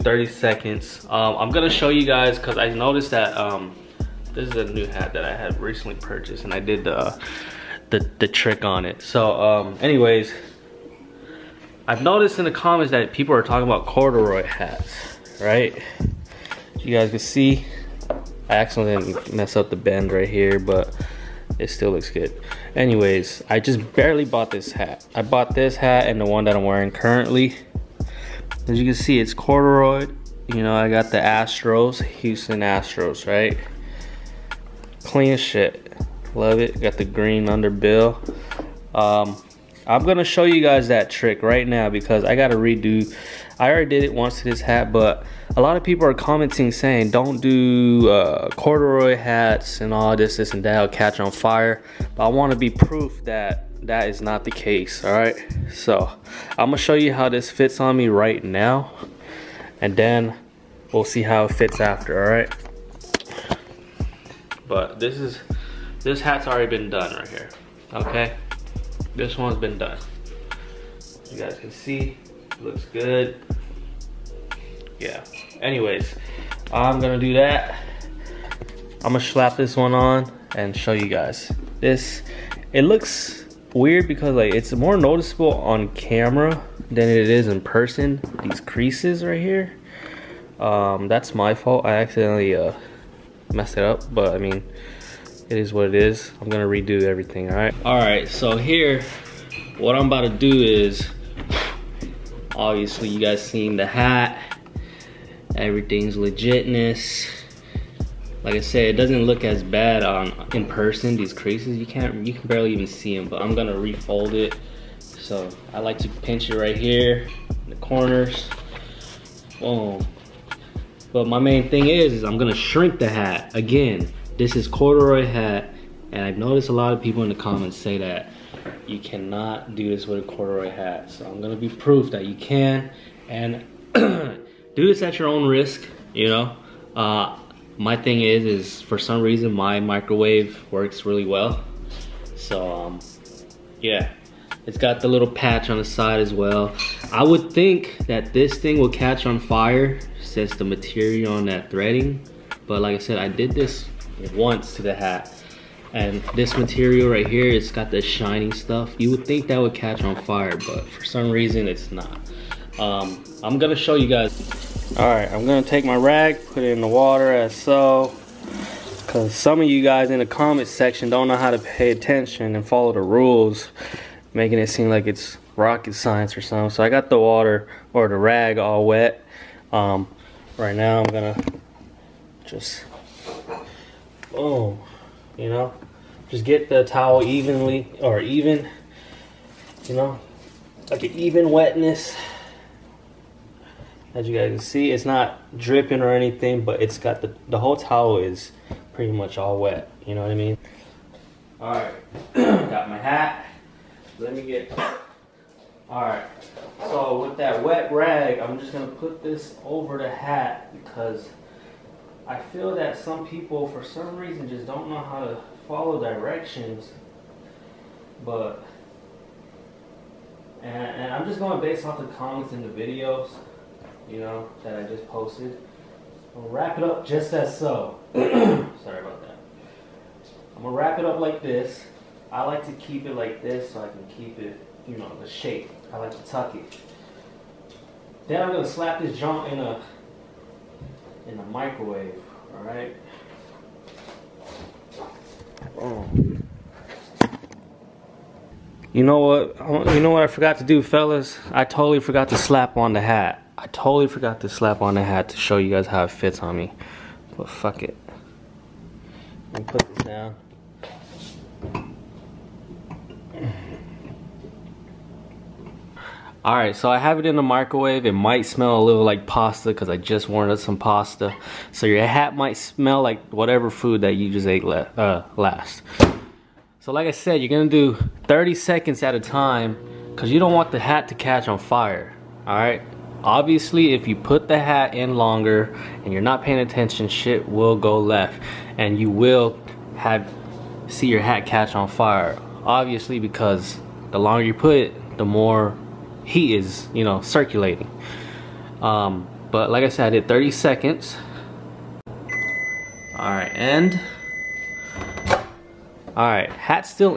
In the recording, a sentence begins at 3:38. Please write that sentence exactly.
But, and, and I'm just going based off the comments in the videos, you know, that I just posted.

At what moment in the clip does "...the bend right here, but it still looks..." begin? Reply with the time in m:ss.
0:19.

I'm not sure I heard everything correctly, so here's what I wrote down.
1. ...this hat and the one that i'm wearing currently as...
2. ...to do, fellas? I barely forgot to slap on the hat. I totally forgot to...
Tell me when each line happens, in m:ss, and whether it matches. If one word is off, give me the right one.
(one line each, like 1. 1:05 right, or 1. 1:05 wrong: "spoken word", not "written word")
1. 0:25 right
2. 4:10 wrong: "totally", not "barely".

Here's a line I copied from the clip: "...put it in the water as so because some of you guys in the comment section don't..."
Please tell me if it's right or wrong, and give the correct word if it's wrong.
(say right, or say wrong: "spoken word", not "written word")
right.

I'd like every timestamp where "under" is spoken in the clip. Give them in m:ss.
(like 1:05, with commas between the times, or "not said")
0:37.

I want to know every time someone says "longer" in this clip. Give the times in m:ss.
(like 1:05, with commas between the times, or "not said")
4:45, 4:54.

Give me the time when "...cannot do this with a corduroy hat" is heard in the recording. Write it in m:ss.
2:08.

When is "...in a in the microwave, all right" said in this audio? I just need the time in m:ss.
3:59.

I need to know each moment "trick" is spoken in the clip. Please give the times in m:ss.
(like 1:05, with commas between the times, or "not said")
0:08, 0:41.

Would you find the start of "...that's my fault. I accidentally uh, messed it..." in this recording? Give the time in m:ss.
1:31.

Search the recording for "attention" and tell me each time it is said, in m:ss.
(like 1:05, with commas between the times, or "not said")
2:51, 4:46.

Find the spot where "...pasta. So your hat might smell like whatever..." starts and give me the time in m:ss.
4:30.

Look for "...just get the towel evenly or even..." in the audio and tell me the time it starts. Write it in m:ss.
3:06.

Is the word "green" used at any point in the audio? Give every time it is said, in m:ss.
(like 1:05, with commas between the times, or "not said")
0:37.